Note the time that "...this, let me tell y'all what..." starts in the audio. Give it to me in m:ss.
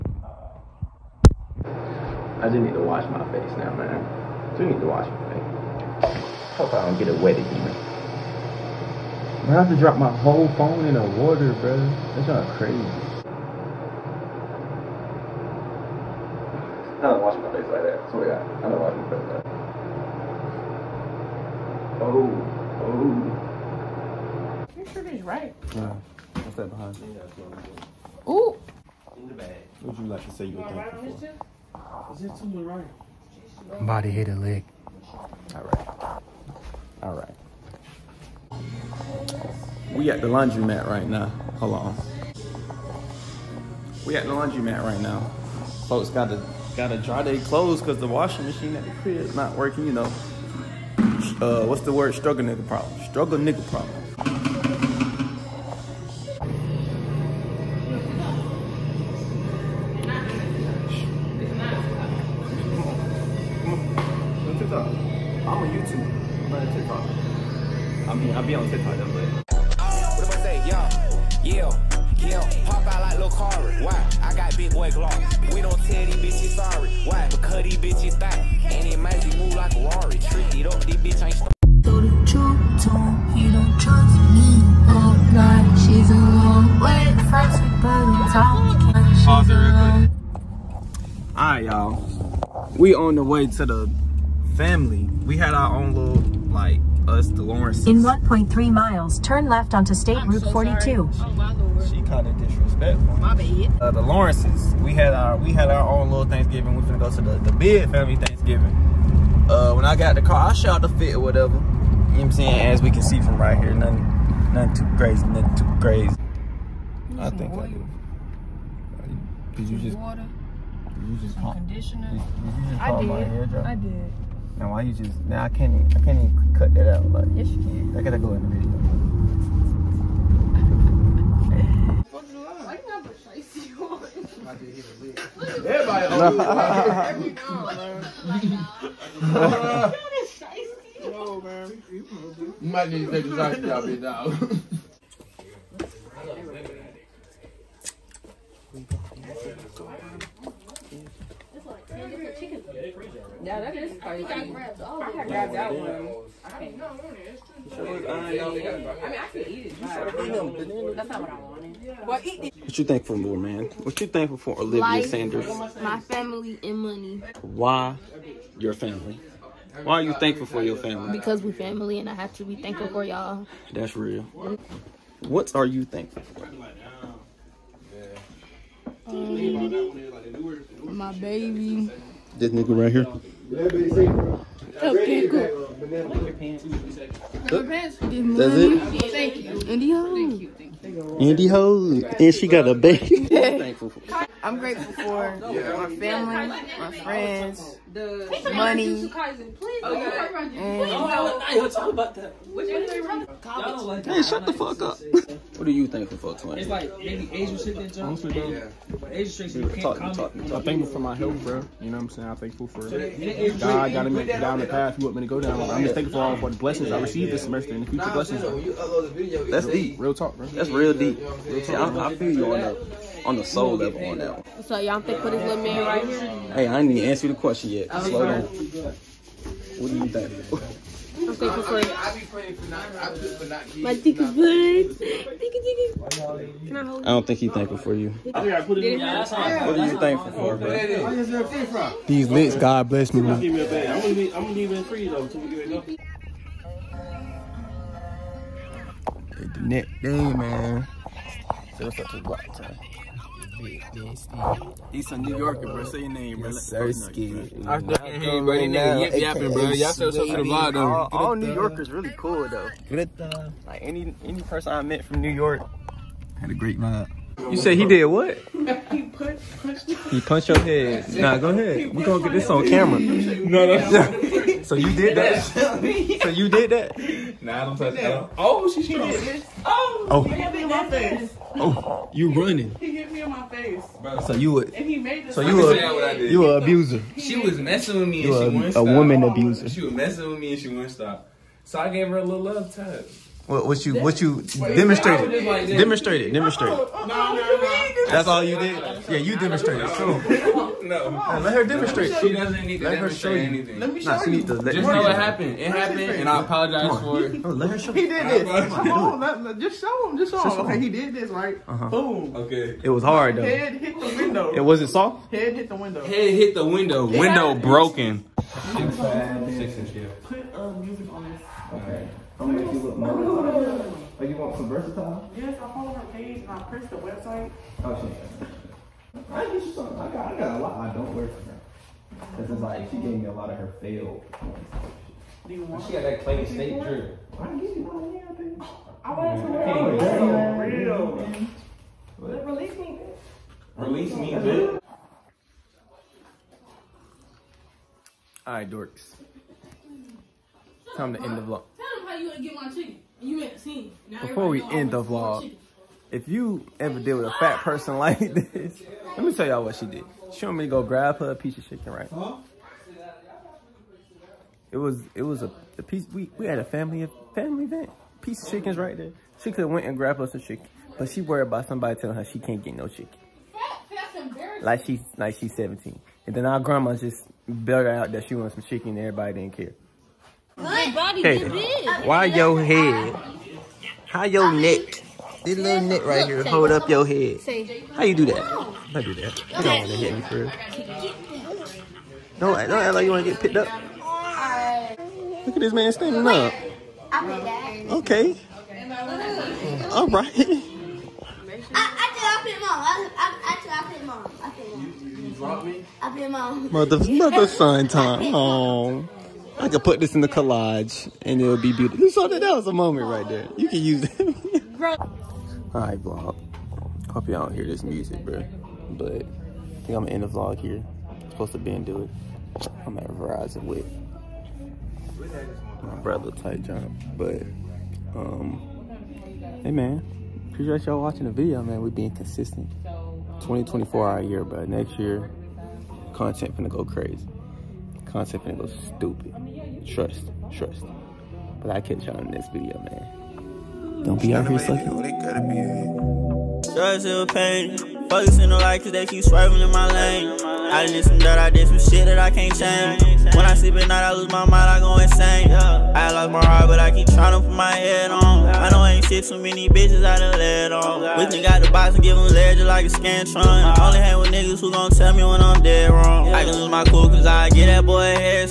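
5:58.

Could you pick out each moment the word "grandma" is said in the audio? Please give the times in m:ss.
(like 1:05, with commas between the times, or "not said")
6:16.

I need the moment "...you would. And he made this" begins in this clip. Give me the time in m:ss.
4:44.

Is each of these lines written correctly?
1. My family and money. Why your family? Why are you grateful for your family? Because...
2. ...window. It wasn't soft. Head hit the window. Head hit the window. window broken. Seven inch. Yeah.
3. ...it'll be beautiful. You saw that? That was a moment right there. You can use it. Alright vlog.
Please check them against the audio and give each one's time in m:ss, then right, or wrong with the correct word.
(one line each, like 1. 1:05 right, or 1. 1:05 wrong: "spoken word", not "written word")
1. 2:45 wrong: "thankful", not "grateful"
2. 5:14 wrong: "Six", not "Seven"
3. 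6:51 right.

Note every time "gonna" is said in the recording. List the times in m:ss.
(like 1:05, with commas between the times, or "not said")
1:46, 4:04, 4:32, 5:22, 7:00.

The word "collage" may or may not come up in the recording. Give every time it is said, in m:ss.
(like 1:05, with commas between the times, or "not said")
6:50.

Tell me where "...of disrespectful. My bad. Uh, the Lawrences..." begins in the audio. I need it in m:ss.
1:42.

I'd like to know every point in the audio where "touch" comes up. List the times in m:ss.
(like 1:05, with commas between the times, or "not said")
4:37, 4:52.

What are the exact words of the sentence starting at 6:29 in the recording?
You don't want to hit me for real.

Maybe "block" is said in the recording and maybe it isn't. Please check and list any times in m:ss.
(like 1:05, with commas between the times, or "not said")
4:12.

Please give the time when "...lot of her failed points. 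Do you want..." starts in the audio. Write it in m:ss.
5:33.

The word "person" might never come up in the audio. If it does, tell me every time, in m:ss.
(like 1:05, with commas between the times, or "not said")
4:24, 5:57.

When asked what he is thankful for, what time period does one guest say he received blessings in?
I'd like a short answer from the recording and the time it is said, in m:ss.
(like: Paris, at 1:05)
This semester, at 3:37.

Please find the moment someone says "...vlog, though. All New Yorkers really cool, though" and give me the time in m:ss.
4:20.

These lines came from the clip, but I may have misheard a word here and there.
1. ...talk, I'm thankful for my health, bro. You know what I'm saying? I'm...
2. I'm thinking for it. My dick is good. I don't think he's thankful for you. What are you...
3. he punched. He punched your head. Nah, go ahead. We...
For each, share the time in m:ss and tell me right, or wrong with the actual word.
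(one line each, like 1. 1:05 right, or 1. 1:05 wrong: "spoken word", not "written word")
1. 3:30 right
2. 3:51 right
3. 4:28 right.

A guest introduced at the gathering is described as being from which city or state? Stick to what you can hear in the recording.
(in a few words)
New York.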